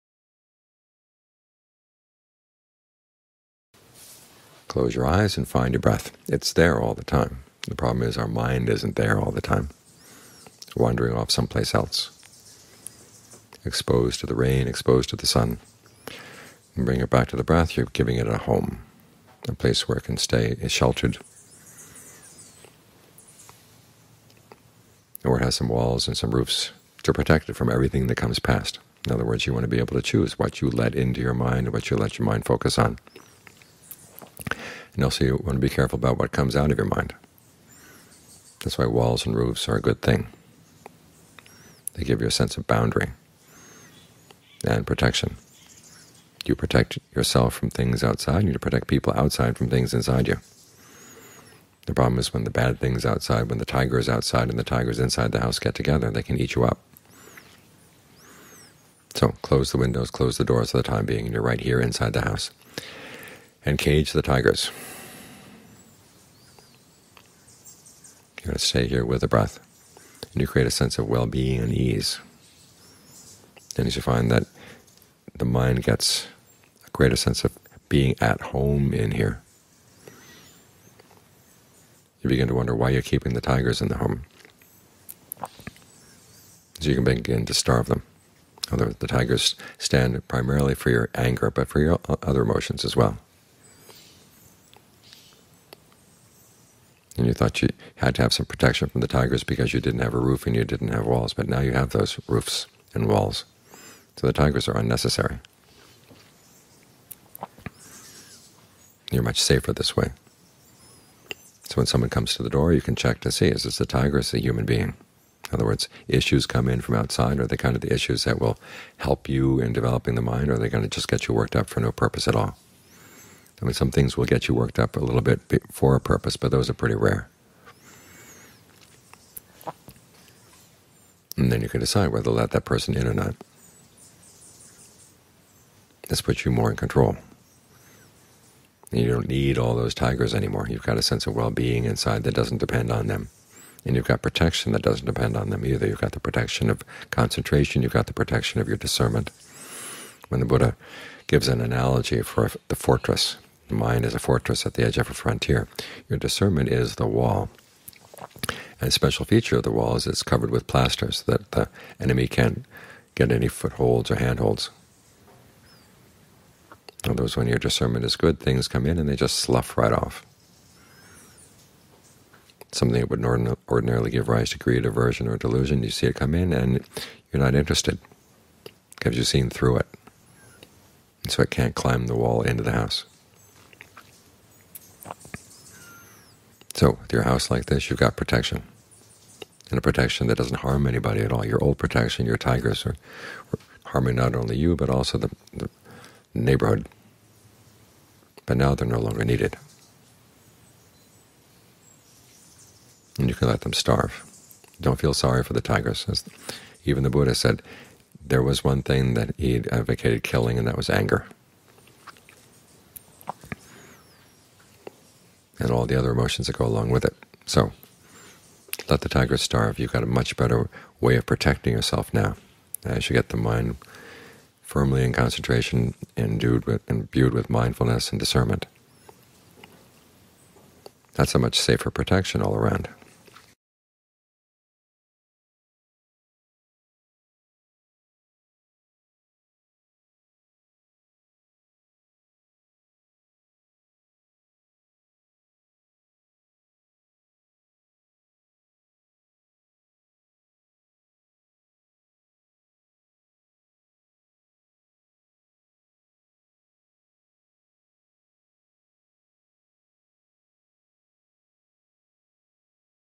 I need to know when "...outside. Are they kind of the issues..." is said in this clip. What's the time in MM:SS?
01:56.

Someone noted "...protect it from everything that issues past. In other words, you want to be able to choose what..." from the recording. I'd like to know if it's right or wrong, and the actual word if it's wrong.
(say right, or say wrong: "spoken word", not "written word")
wrong: "comes", not "issues".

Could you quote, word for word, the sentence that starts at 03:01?
And so it can't climb the wall into the house.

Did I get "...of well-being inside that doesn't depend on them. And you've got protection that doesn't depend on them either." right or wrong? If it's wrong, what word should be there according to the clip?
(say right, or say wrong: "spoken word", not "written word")
right.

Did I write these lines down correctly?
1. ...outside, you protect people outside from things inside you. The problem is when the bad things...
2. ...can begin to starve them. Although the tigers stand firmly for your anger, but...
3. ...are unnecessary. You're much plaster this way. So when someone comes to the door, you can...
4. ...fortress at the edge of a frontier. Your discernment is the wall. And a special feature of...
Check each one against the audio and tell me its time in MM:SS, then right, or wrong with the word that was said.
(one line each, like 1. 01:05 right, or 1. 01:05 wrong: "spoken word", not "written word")
1. 00:48 right
2. 01:26 wrong: "primarily", not "firmly"
3. 01:44 wrong: "safer", not "plaster"
4. 02:34 right.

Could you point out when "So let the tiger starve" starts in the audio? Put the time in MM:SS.
03:37.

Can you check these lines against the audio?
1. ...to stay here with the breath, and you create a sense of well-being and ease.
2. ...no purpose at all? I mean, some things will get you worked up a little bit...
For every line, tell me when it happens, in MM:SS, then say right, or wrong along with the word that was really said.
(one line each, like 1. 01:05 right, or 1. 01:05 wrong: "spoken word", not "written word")
1. 01:08 right
2. 02:01 right.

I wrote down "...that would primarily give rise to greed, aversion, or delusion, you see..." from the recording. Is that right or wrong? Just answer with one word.
wrong.